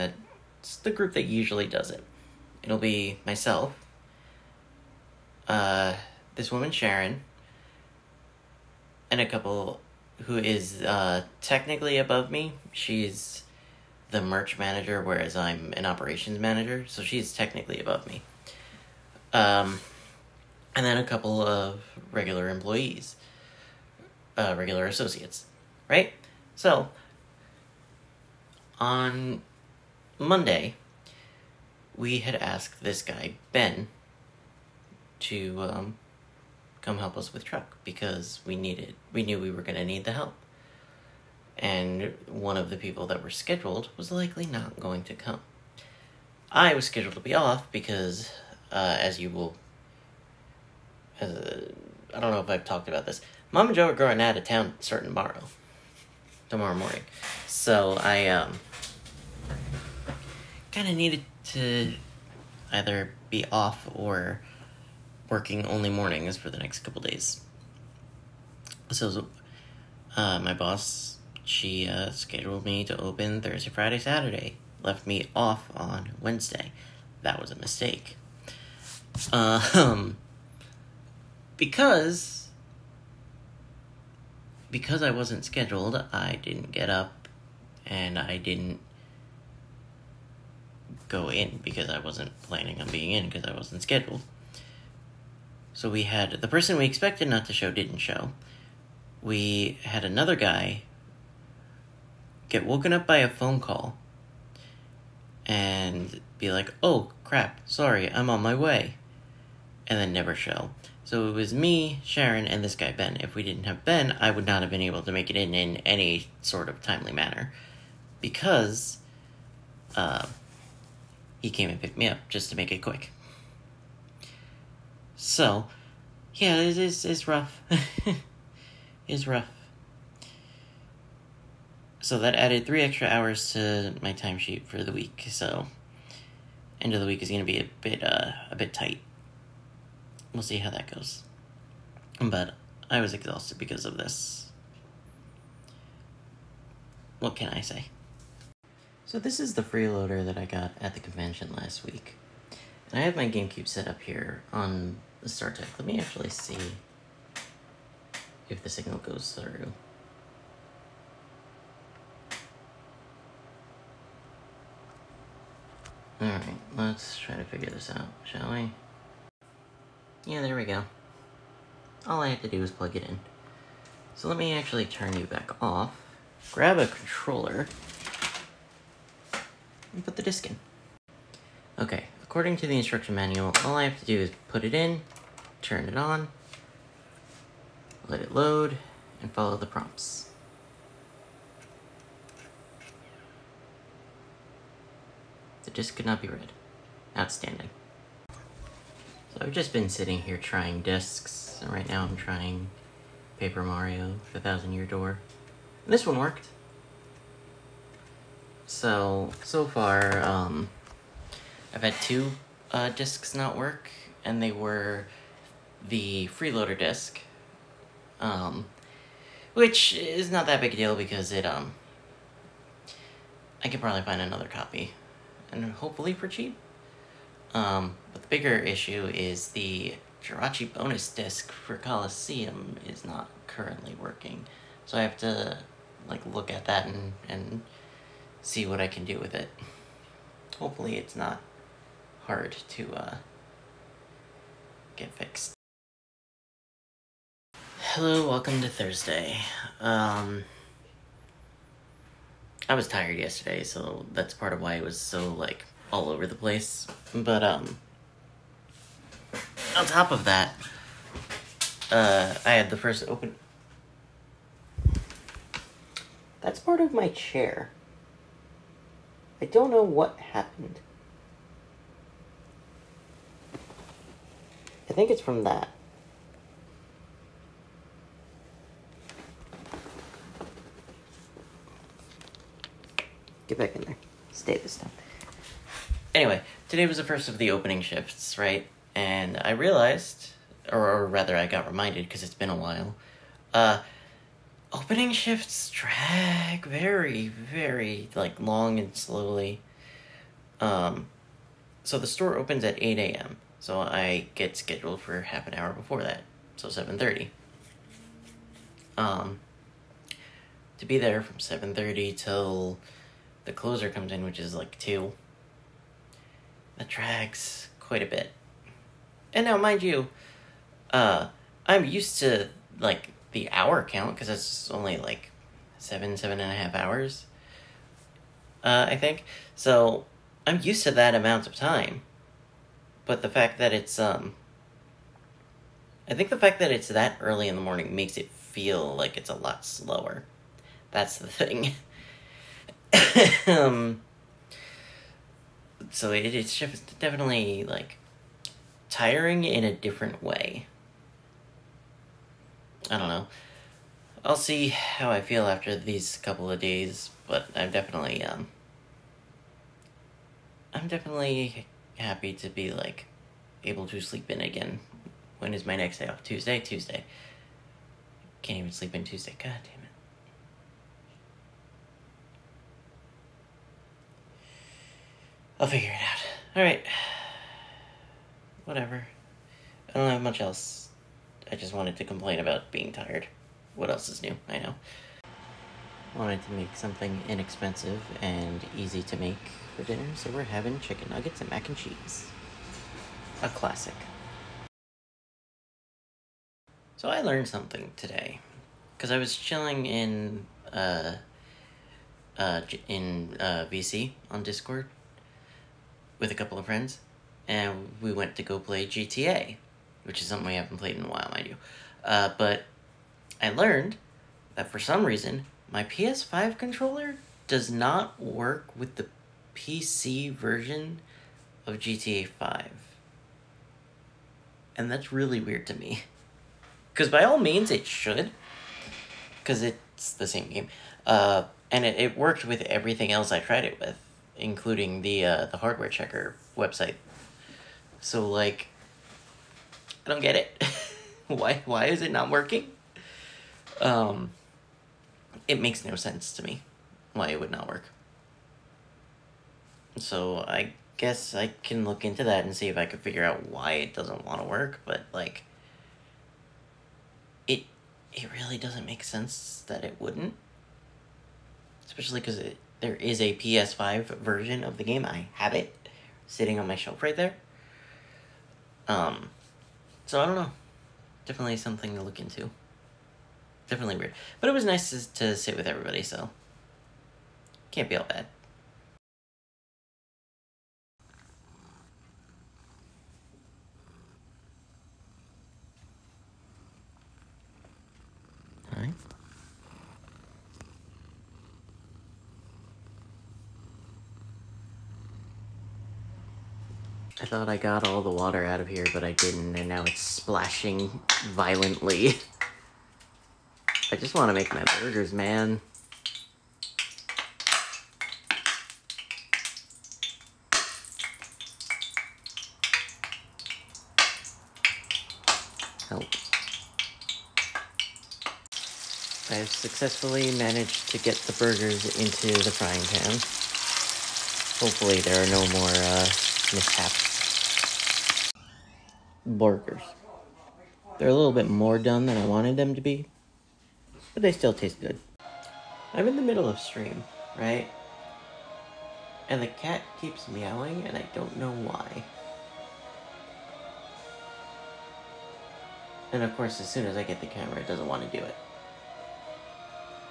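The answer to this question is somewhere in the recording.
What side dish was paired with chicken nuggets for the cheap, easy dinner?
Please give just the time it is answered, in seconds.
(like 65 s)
391 s.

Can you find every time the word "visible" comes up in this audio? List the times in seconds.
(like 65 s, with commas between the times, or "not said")
not said.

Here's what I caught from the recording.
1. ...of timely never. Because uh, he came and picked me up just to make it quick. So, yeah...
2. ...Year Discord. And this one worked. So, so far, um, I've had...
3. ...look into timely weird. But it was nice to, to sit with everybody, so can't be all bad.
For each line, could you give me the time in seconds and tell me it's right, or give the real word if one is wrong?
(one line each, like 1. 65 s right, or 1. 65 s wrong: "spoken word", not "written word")
1. 116 s wrong: "manner", not "never"
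2. 204 s wrong: "Door", not "Discord"
3. 472 s wrong: "definitely", not "timely".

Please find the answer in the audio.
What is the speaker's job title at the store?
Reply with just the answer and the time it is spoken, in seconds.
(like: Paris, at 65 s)
operations manager, at 15 s.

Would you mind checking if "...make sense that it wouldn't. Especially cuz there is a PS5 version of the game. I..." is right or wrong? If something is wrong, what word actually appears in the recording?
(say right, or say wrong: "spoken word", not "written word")
right.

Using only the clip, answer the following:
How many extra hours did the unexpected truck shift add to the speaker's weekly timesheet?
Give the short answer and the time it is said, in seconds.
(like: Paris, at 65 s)
3, at 132 s.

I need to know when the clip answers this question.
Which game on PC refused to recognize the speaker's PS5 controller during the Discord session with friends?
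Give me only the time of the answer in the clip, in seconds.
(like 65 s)
421 s.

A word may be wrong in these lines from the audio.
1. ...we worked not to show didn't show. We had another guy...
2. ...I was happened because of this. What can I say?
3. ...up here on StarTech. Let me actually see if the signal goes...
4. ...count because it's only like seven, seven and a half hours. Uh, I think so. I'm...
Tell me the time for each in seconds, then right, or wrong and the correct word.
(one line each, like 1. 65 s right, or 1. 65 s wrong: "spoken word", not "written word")
1. 96 s wrong: "expected", not "worked"
2. 142 s wrong: "exhausted", not "happened"
3. 153 s right
4. 323 s right.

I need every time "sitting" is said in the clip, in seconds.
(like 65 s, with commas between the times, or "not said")
199 s, 466 s.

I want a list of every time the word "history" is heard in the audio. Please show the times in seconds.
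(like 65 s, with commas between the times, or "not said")
not said.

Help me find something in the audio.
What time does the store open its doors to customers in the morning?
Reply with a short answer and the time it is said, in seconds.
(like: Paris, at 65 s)
8 a.m., at 302 s.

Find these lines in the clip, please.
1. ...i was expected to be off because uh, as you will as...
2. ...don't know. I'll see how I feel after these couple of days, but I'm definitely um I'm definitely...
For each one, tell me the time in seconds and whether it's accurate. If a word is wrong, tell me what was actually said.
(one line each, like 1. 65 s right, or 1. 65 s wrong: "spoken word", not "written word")
1. 46 s wrong: "scheduled", not "expected"
2. 352 s right.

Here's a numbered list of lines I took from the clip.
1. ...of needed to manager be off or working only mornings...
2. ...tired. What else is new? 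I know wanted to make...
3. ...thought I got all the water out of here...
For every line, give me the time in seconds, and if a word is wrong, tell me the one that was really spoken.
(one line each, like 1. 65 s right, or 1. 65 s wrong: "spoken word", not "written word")
1. 60 s wrong: "either", not "manager"
2. 382 s right
3. 497 s right.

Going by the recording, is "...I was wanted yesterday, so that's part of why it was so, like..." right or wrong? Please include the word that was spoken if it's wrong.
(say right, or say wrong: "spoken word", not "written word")
wrong: "tired", not "wanted".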